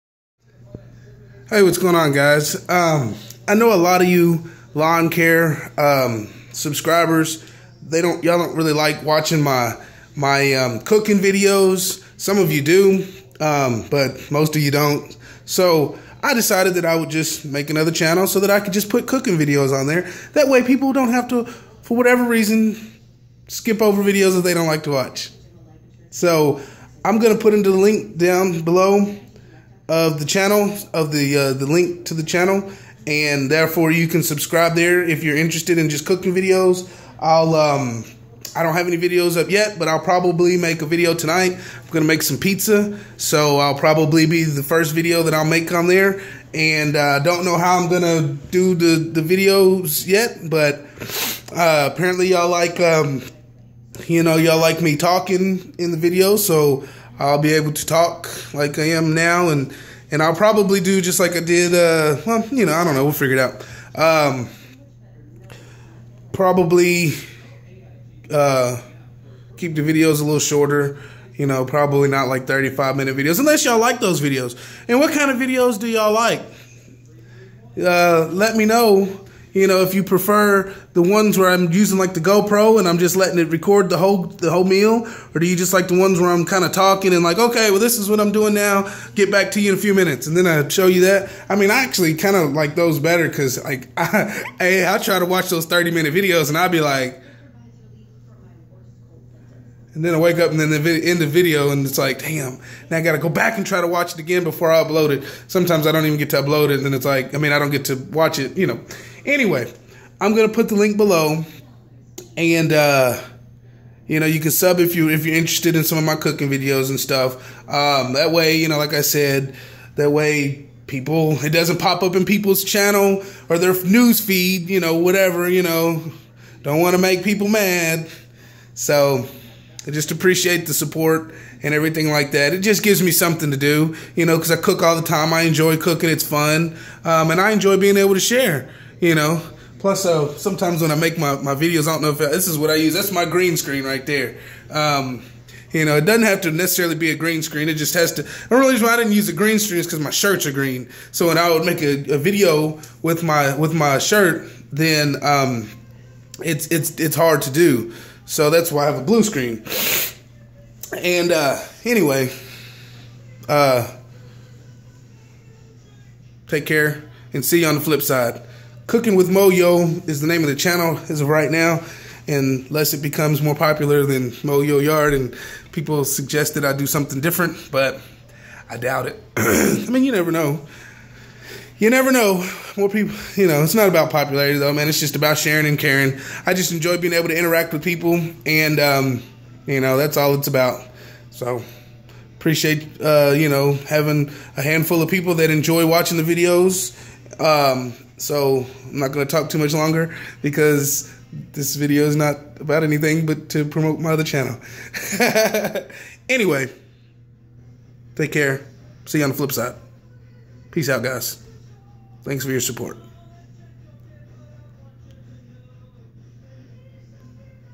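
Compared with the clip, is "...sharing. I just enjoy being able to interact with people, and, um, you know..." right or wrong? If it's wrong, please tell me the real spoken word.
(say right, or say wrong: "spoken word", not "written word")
wrong: "caring", not "sharing".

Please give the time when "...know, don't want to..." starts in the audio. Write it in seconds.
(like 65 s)
125 s.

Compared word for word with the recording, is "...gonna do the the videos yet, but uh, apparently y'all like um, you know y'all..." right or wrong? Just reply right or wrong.
right.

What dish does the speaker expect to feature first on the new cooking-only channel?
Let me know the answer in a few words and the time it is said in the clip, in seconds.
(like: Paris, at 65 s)
pizza, at 42 s.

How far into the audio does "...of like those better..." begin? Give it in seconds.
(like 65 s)
92 s.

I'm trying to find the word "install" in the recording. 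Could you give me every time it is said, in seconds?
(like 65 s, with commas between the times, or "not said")
not said.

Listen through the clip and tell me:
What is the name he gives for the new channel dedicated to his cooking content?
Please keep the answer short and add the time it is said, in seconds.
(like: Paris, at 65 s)
Cooking with Moyo, at 168 s.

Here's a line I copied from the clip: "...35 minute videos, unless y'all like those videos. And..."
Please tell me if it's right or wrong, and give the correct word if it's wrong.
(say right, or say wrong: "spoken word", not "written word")
right.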